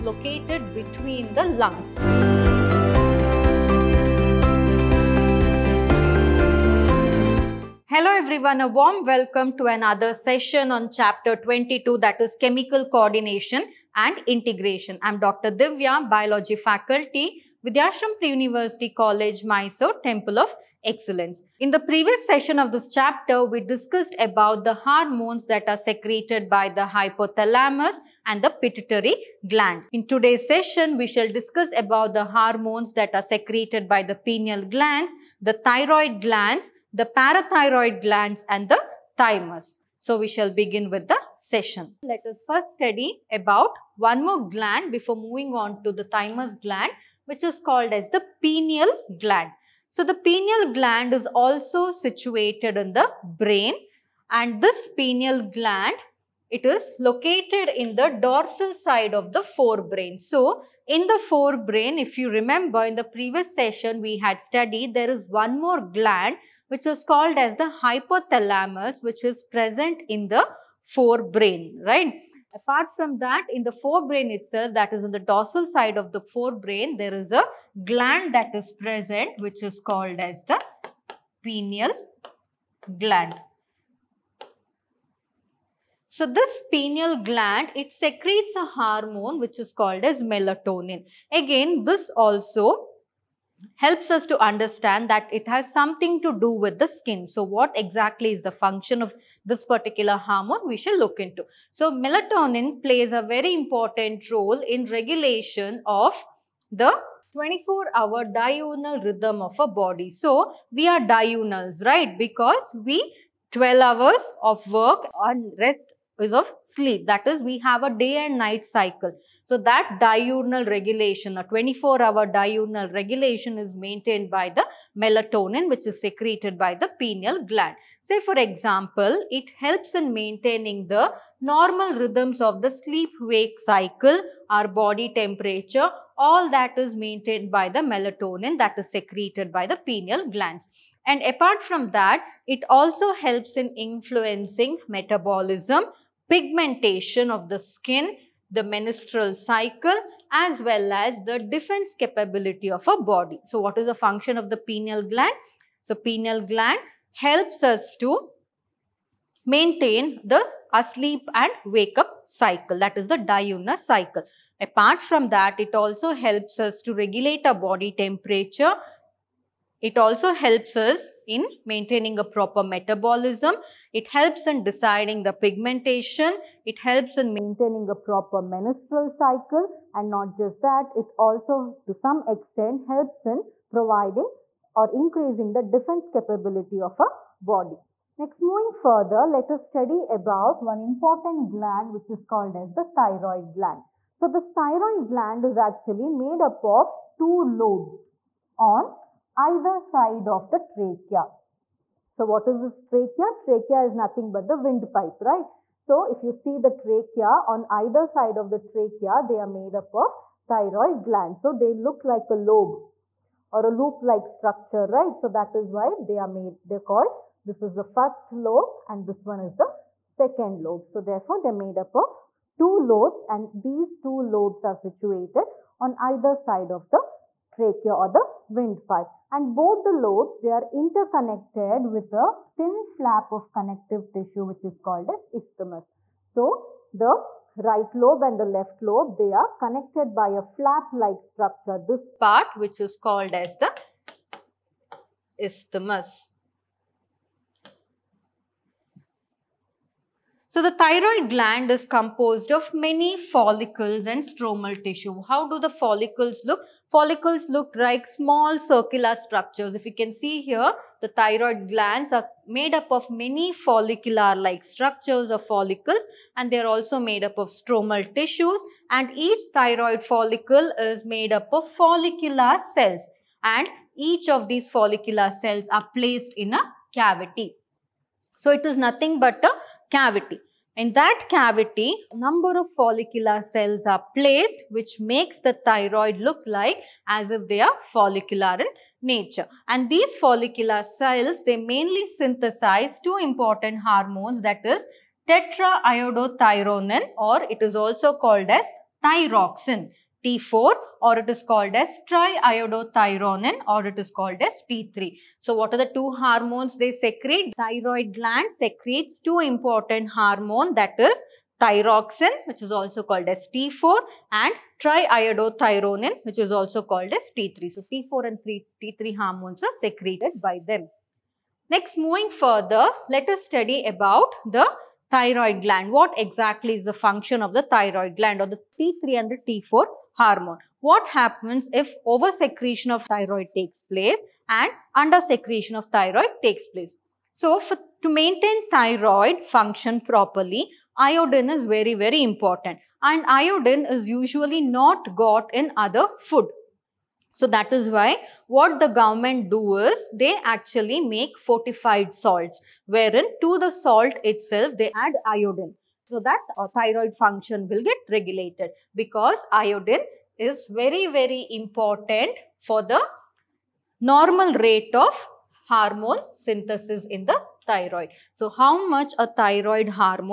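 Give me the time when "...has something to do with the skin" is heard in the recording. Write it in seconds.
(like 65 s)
95 s.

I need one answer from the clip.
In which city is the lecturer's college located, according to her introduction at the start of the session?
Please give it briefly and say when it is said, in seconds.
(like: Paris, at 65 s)
Mysore, at 19 s.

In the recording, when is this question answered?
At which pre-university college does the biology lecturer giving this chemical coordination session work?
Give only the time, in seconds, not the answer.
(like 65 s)
17 s.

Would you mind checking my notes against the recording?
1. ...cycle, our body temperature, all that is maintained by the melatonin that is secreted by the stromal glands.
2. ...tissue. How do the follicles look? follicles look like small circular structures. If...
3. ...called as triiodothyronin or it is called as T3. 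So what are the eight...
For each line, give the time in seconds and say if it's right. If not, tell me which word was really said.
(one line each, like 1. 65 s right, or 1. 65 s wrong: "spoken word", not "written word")
1. 133 s wrong: "pineal", not "stromal"
2. 254 s right
3. 301 s wrong: "two", not "eight".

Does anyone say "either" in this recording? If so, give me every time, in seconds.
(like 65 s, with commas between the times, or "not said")
199 s, 207 s, 225 s.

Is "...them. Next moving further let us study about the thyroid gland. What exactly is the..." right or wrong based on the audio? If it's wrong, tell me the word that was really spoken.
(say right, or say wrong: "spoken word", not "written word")
right.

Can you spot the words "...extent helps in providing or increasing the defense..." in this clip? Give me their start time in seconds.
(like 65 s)
182 s.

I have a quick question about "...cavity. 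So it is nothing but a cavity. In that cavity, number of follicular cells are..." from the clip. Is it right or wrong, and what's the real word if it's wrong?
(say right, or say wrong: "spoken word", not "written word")
right.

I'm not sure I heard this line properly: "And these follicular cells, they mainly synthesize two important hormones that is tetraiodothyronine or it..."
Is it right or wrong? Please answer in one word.
right.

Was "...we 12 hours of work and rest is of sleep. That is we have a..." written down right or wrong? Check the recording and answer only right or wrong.
right.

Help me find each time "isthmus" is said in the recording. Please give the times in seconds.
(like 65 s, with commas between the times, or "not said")
235 s, 245 s.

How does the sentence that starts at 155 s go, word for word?
So pineal gland helps us to maintain the asleep and wake up cycle that is the diurnal cycle.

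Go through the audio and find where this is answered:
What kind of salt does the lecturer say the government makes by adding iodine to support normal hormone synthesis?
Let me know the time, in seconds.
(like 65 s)
351 s.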